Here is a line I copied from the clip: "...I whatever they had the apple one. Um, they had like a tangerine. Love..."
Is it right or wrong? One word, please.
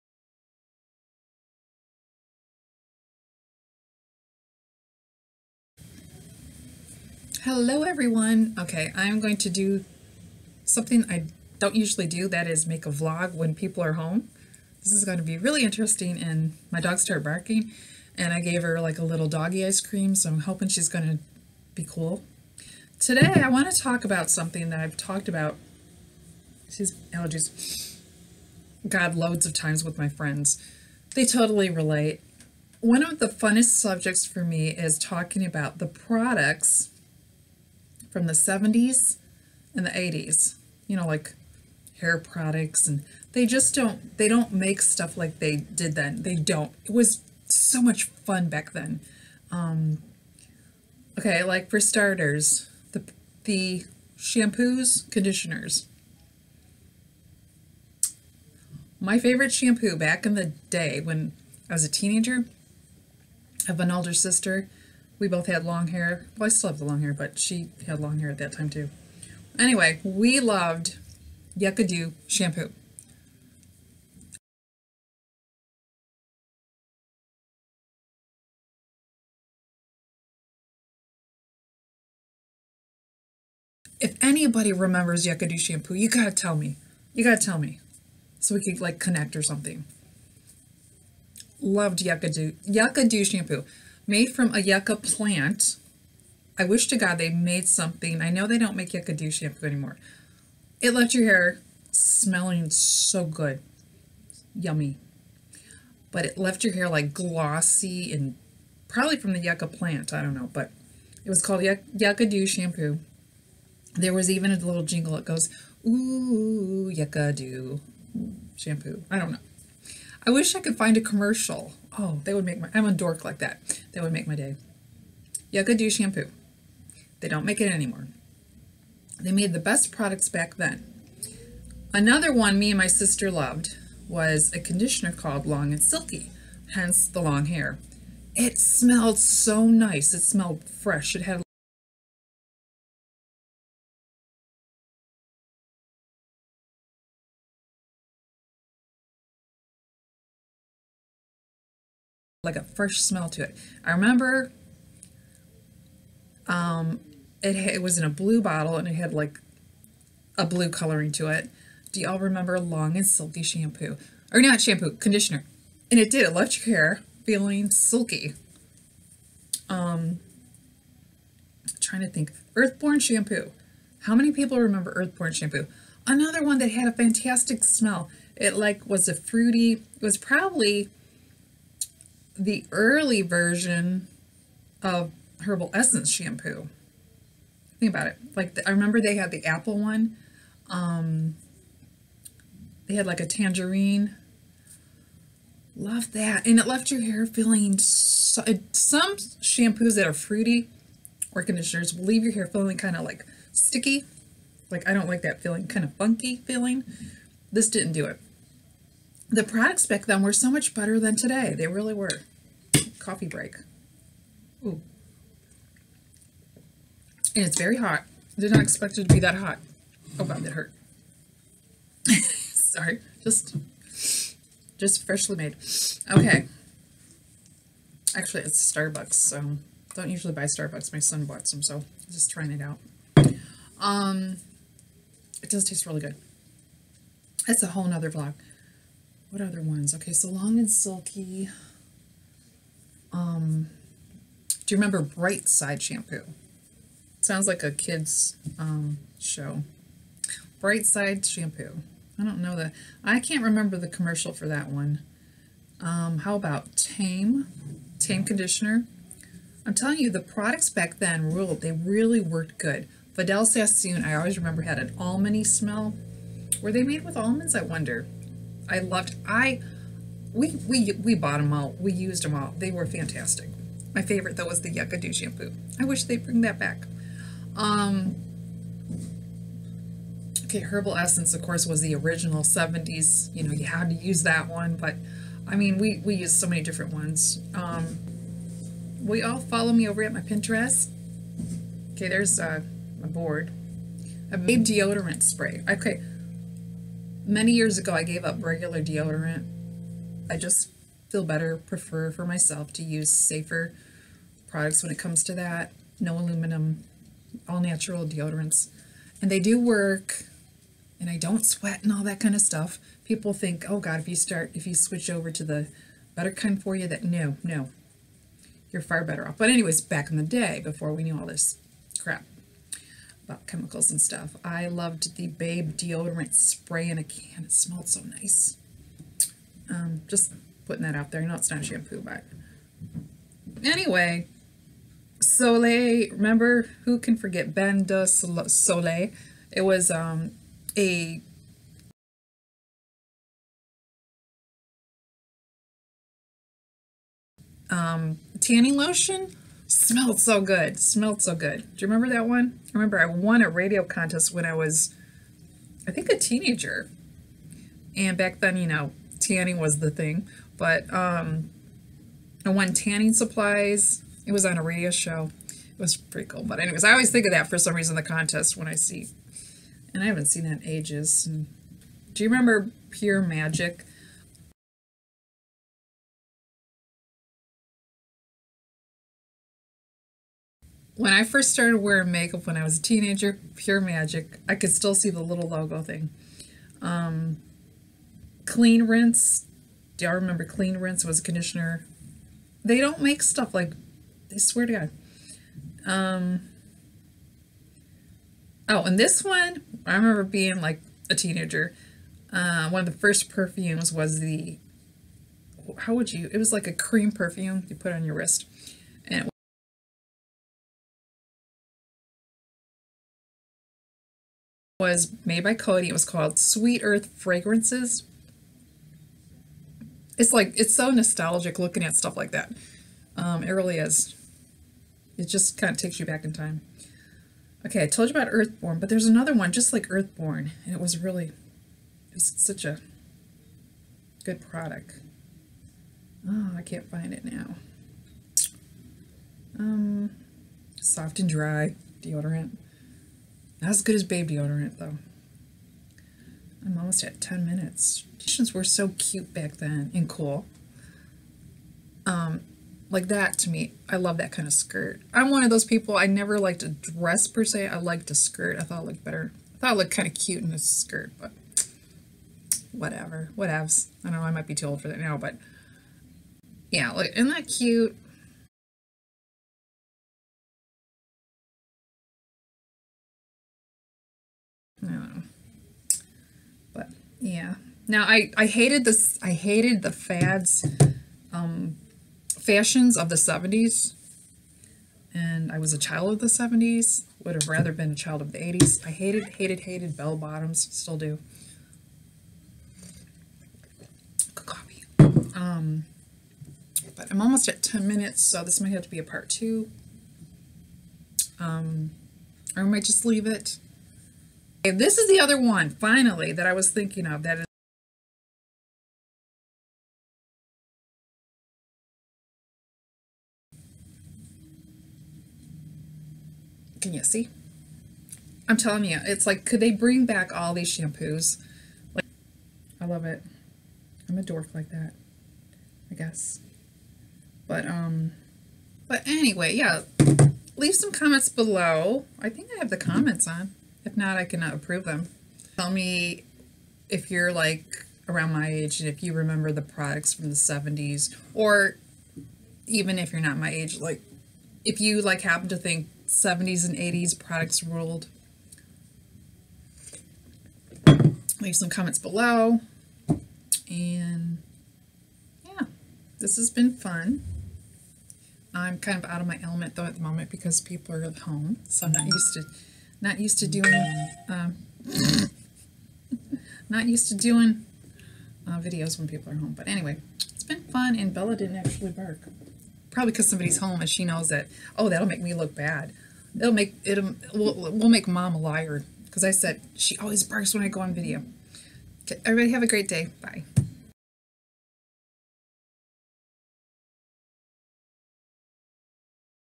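wrong.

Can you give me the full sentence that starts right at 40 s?
You know, like hair products and they just don't they don't make stuff like they did then.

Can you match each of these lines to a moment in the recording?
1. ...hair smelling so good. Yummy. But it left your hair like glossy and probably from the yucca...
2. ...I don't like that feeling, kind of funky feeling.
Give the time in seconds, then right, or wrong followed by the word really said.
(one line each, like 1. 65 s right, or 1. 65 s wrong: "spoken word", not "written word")
1. 101 s right
2. 204 s right.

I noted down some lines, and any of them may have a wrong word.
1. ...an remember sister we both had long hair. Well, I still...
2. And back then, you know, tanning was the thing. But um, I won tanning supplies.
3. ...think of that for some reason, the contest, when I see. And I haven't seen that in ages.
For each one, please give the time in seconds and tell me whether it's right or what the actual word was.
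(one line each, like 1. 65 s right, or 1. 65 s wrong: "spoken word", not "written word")
1. 63 s wrong: "older", not "remember"
2. 357 s right
3. 367 s right.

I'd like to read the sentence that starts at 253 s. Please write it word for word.
I can't remember the commercial for that one.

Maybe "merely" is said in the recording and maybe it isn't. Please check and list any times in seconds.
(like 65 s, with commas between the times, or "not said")
not said.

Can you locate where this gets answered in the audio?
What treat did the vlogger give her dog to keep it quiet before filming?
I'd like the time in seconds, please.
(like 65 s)
19 s.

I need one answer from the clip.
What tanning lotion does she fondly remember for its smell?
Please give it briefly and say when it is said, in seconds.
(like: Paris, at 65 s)
Bain de Soleil, at 337 s.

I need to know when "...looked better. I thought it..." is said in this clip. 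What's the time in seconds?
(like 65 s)
458 s.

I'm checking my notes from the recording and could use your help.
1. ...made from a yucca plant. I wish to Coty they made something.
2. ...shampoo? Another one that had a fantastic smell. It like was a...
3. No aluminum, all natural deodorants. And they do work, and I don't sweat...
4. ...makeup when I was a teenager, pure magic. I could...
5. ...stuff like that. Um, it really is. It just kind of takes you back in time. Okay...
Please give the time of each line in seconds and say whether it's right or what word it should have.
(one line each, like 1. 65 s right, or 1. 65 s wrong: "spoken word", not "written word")
1. 94 s wrong: "God", not "Coty"
2. 175 s right
3. 305 s right
4. 382 s right
5. 421 s right.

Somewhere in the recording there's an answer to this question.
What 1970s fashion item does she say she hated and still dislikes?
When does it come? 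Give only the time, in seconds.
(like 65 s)
489 s.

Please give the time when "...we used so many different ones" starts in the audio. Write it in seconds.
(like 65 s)
286 s.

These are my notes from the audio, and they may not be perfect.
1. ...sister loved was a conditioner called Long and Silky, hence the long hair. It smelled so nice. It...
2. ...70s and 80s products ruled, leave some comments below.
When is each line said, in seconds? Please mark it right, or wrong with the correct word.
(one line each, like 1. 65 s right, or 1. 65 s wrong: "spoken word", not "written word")
1. 132 s right
2. 546 s right.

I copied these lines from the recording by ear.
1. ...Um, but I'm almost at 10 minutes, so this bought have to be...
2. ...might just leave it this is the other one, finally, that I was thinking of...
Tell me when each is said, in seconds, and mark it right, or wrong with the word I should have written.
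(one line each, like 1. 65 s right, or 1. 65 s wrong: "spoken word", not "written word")
1. 495 s wrong: "might", not "bought"
2. 502 s right.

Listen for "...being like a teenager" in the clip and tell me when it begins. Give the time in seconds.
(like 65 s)
400 s.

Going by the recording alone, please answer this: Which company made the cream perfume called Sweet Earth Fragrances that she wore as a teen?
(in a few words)
Coty.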